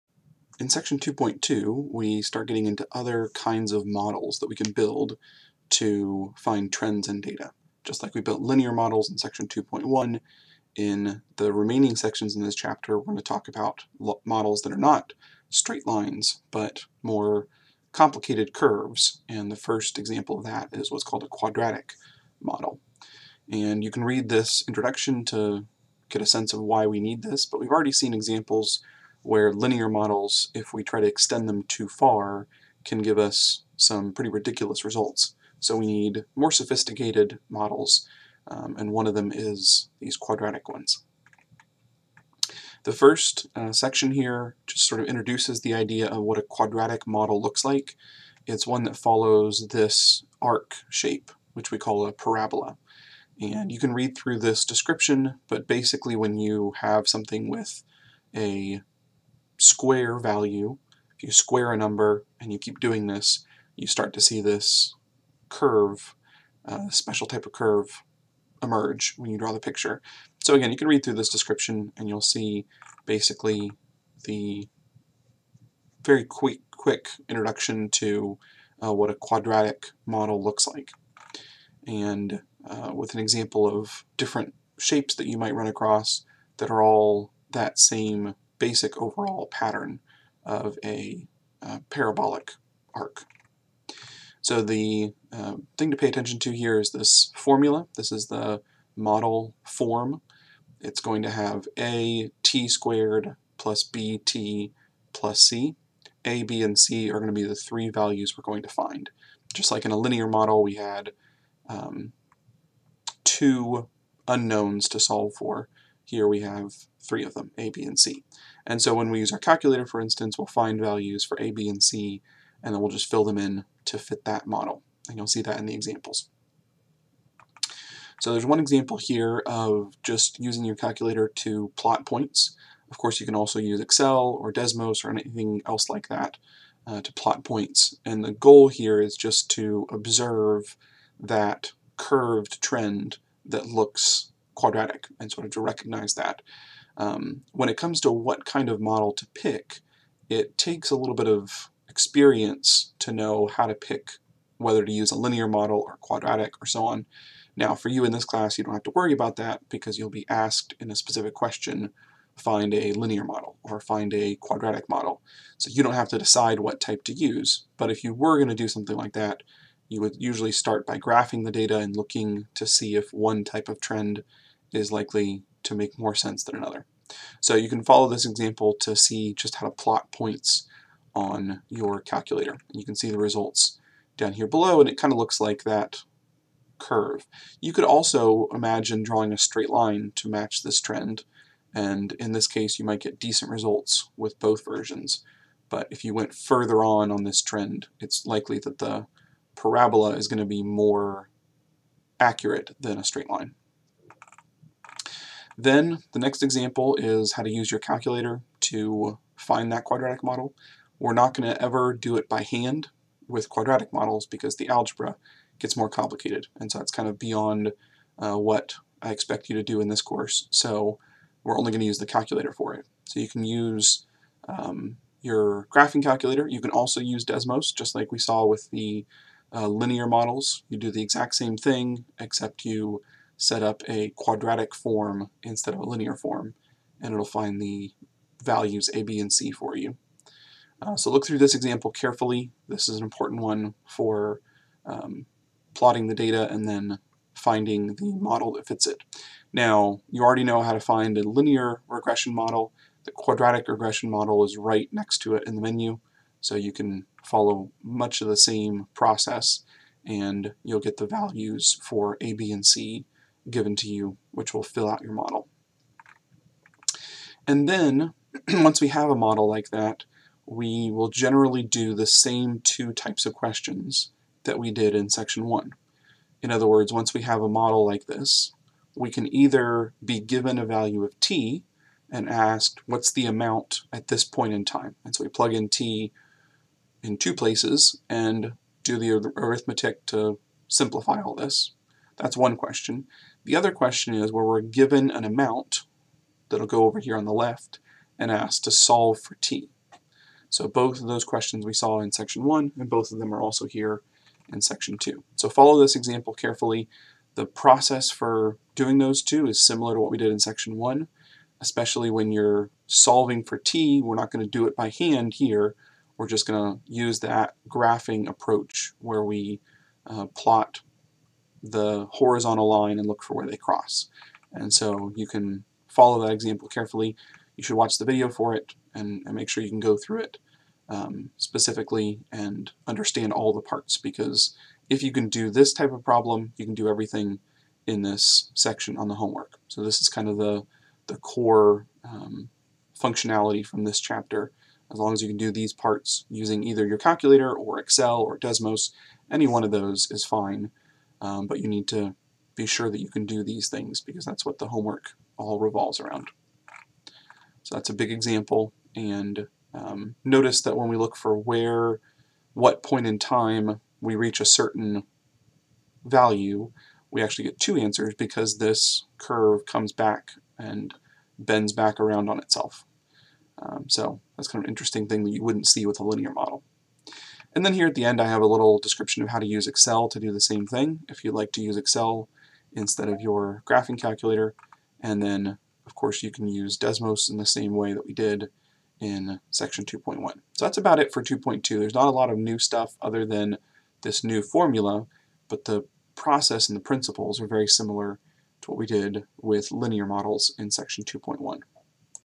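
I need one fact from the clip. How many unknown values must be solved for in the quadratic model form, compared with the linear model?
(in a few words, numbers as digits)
3.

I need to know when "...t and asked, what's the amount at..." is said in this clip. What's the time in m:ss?
4:41.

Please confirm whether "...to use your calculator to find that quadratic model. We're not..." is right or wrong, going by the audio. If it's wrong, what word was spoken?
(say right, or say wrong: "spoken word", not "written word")
right.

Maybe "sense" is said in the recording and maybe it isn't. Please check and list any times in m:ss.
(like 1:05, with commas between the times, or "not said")
0:26, 2:56.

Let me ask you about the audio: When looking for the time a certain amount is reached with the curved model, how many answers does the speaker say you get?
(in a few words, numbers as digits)
2.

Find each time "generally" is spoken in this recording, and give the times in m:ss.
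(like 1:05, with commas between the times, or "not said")
4:31.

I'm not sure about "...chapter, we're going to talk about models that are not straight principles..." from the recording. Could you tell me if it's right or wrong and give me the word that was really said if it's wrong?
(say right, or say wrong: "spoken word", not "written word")
wrong: "lines", not "principles".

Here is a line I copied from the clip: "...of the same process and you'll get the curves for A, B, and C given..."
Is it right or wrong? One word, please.
wrong.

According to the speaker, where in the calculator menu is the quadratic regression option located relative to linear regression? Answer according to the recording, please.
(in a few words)
right next to it.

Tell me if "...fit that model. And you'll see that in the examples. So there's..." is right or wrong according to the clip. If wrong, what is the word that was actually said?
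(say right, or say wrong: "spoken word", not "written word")
right.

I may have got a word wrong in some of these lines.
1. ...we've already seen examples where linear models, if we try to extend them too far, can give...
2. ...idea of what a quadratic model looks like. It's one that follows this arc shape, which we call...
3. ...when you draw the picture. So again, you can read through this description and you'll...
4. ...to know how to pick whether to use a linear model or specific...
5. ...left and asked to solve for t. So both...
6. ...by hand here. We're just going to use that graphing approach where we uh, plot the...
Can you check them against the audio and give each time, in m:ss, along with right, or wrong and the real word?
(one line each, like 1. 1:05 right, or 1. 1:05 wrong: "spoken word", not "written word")
1. 0:27 right
2. 0:45 right
3. 1:09 right
4. 2:32 wrong: "quadratic", not "specific"
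5. 4:57 right
6. 5:14 right.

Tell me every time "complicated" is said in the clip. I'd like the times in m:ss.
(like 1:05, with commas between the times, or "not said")
0:17, 3:35.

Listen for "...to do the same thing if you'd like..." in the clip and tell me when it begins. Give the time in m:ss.
6:20.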